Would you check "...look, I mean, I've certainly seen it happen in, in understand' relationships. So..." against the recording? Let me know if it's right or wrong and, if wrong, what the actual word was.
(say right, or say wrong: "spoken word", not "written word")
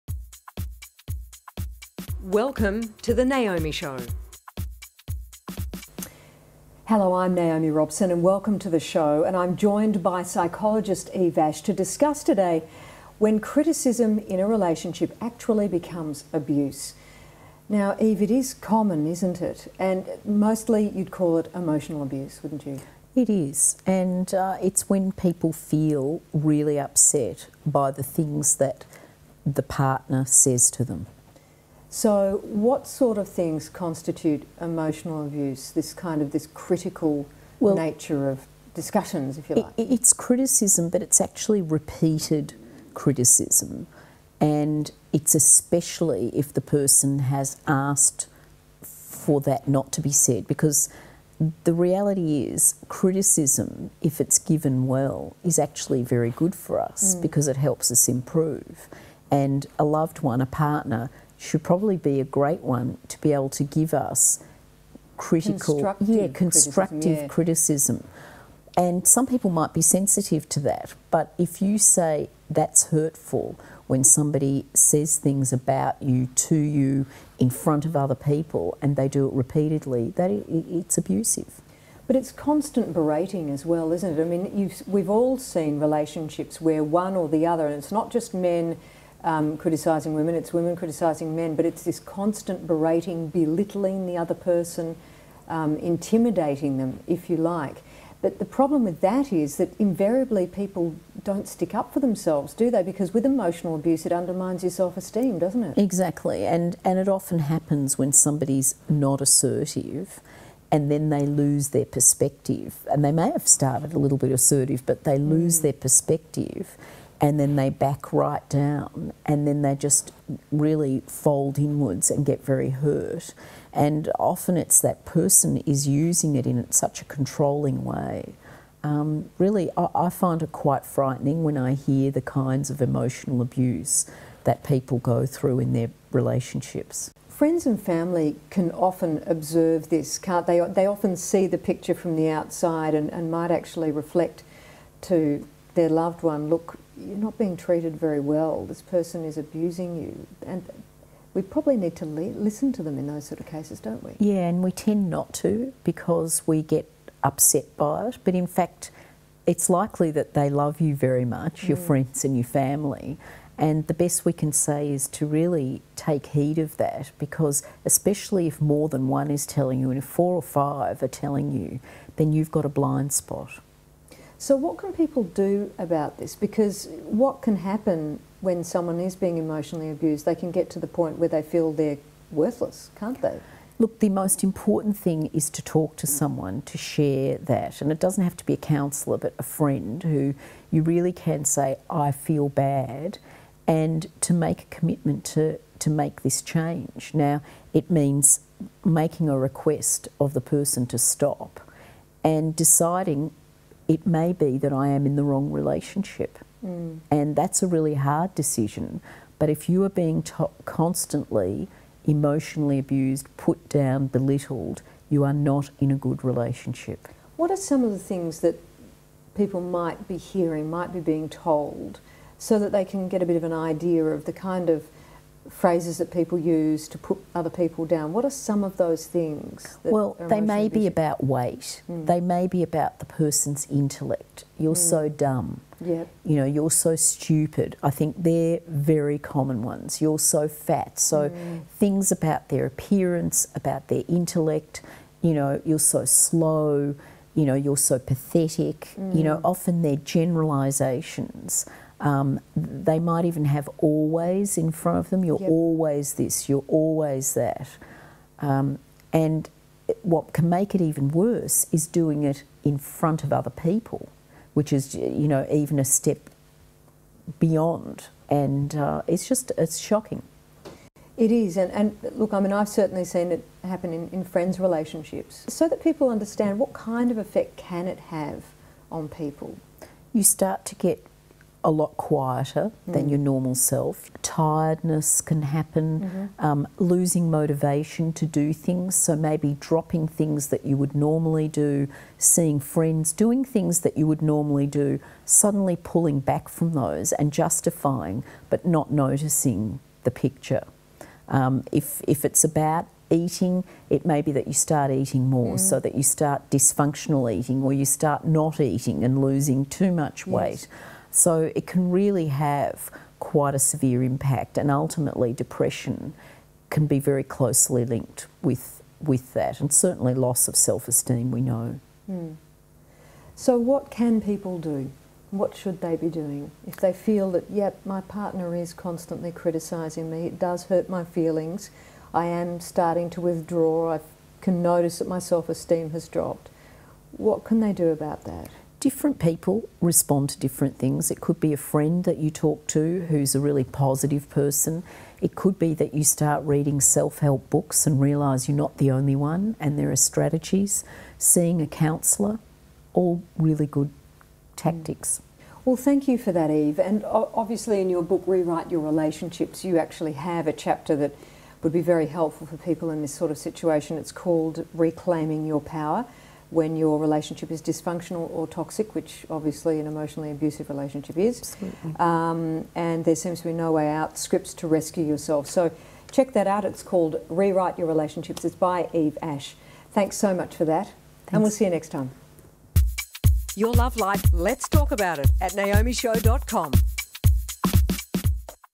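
wrong: "friends", not "understand".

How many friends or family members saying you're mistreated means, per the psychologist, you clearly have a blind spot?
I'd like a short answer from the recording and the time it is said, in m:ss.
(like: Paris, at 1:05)
four or five, at 2:50.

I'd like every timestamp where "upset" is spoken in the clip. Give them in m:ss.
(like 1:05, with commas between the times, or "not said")
0:26, 2:37.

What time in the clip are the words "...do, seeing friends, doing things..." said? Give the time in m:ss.
4:51.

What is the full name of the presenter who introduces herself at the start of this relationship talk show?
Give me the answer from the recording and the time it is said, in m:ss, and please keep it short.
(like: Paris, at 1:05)
Naomi Robson, at 0:07.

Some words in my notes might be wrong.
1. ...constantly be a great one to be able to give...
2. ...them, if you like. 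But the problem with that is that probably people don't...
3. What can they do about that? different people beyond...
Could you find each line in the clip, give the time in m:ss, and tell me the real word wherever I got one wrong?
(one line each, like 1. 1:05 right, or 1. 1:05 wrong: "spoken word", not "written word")
1. 1:01 wrong: "probably", not "constantly"
2. 1:36 wrong: "invariably", not "probably"
3. 5:37 wrong: "respond", not "beyond".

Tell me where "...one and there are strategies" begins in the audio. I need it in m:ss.
5:49.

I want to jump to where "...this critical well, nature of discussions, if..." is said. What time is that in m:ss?
0:36.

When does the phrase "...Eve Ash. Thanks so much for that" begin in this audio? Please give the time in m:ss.
6:18.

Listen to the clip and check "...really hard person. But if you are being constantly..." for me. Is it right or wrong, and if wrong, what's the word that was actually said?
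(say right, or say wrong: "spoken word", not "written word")
wrong: "decision", not "person".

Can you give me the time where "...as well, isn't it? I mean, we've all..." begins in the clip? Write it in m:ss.
1:23.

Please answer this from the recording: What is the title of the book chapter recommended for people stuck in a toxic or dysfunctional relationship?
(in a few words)
Reclaiming Your Power.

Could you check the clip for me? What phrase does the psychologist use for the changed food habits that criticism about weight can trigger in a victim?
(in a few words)
dysfunctional eating.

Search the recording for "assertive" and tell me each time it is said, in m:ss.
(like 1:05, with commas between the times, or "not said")
1:49, 1:54.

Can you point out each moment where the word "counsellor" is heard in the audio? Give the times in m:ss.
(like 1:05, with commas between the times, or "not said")
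3:08, 5:51.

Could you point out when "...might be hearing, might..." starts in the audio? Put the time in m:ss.
3:39.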